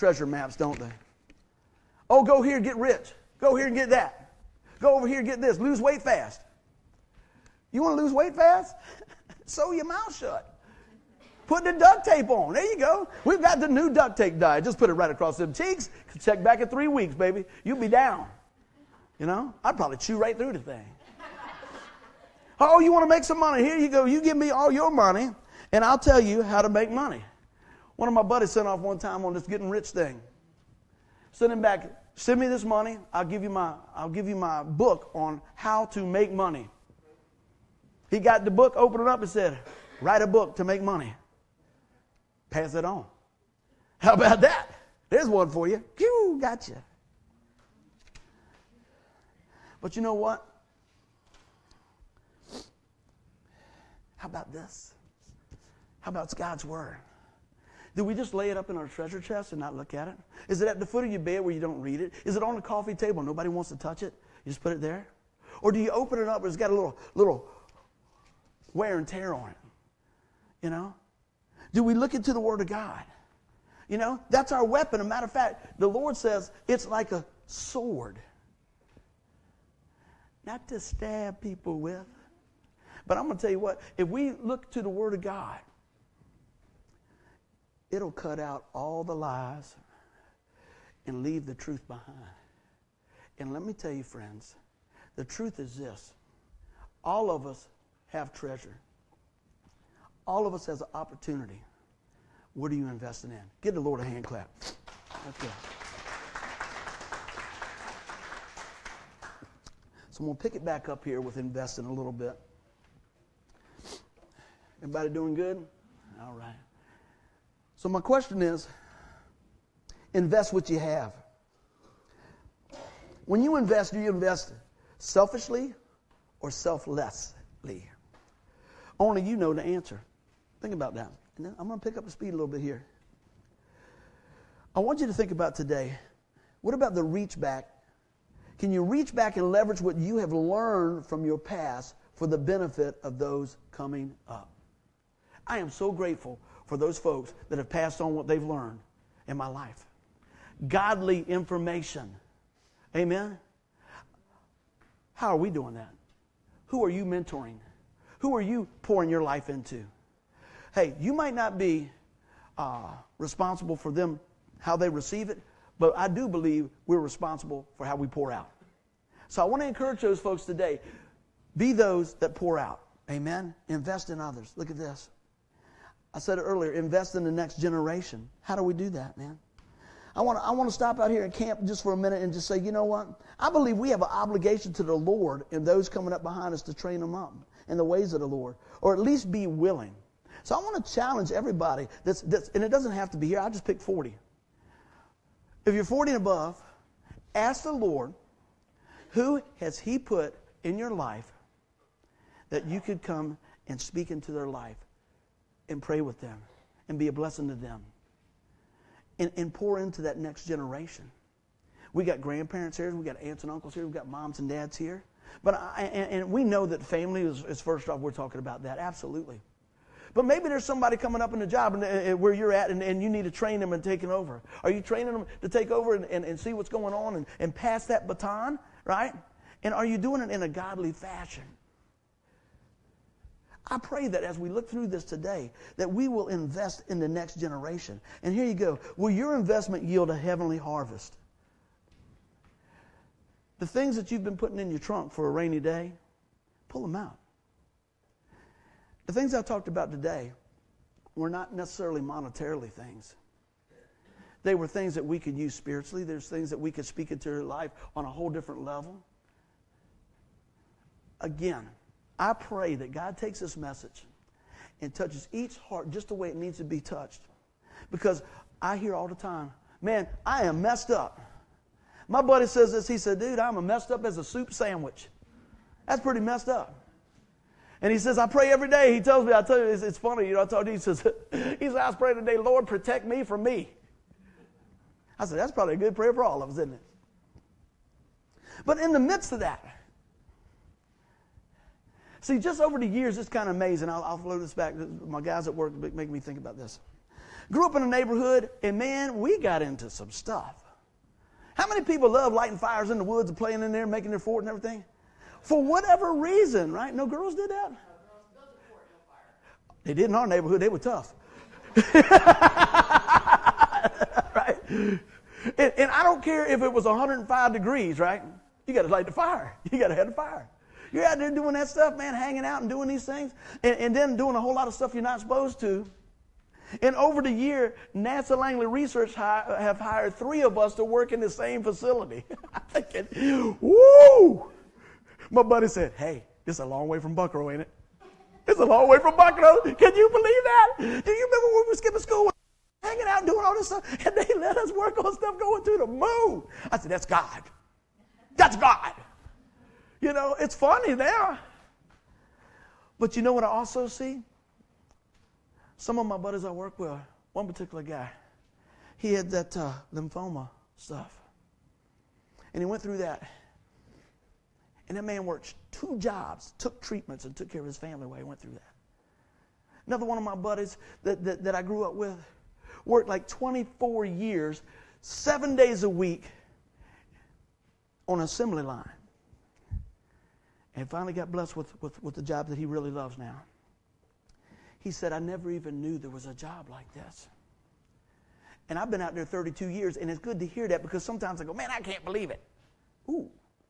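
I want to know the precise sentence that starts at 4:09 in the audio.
The things I talked about today were not necessarily monetarily things.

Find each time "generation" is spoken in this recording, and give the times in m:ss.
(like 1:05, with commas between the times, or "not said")
2:57, 3:30, 3:57.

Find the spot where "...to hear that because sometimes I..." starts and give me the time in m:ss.
6:30.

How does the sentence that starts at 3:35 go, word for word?
But I, and, and, we know that family is, is, first off, we're talking about that, absolutely.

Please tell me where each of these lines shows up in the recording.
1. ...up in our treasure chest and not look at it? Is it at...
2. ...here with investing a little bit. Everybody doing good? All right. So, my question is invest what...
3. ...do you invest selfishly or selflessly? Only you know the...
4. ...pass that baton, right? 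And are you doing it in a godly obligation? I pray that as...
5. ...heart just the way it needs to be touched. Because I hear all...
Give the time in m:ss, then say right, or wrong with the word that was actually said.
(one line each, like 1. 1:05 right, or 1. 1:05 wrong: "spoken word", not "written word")
1. 0:58 right
2. 1:51 right
3. 2:03 right
4. 3:47 wrong: "fashion", not "obligation"
5. 4:25 right.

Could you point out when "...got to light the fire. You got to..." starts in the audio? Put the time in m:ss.
5:18.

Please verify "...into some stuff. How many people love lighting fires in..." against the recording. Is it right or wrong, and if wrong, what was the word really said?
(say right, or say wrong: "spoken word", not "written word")
right.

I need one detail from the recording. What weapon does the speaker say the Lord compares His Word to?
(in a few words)
a sword.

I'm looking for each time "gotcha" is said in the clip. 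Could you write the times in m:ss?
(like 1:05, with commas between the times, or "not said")
0:46.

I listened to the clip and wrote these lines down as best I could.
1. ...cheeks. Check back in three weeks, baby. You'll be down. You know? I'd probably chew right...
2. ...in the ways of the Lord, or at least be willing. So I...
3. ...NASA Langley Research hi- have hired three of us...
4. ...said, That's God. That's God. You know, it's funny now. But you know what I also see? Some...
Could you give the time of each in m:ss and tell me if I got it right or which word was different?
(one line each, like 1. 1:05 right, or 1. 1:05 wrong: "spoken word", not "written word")
1. 0:15 right
2. 3:07 right
3. 5:27 right
4. 5:46 right.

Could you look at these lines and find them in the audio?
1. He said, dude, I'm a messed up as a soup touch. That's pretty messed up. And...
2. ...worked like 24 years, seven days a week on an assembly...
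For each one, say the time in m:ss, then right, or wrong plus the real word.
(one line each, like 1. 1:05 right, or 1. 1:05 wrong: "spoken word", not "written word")
1. 4:32 wrong: "sandwich", not "touch"
2. 6:12 right.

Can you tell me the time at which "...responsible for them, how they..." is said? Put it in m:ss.
2:43.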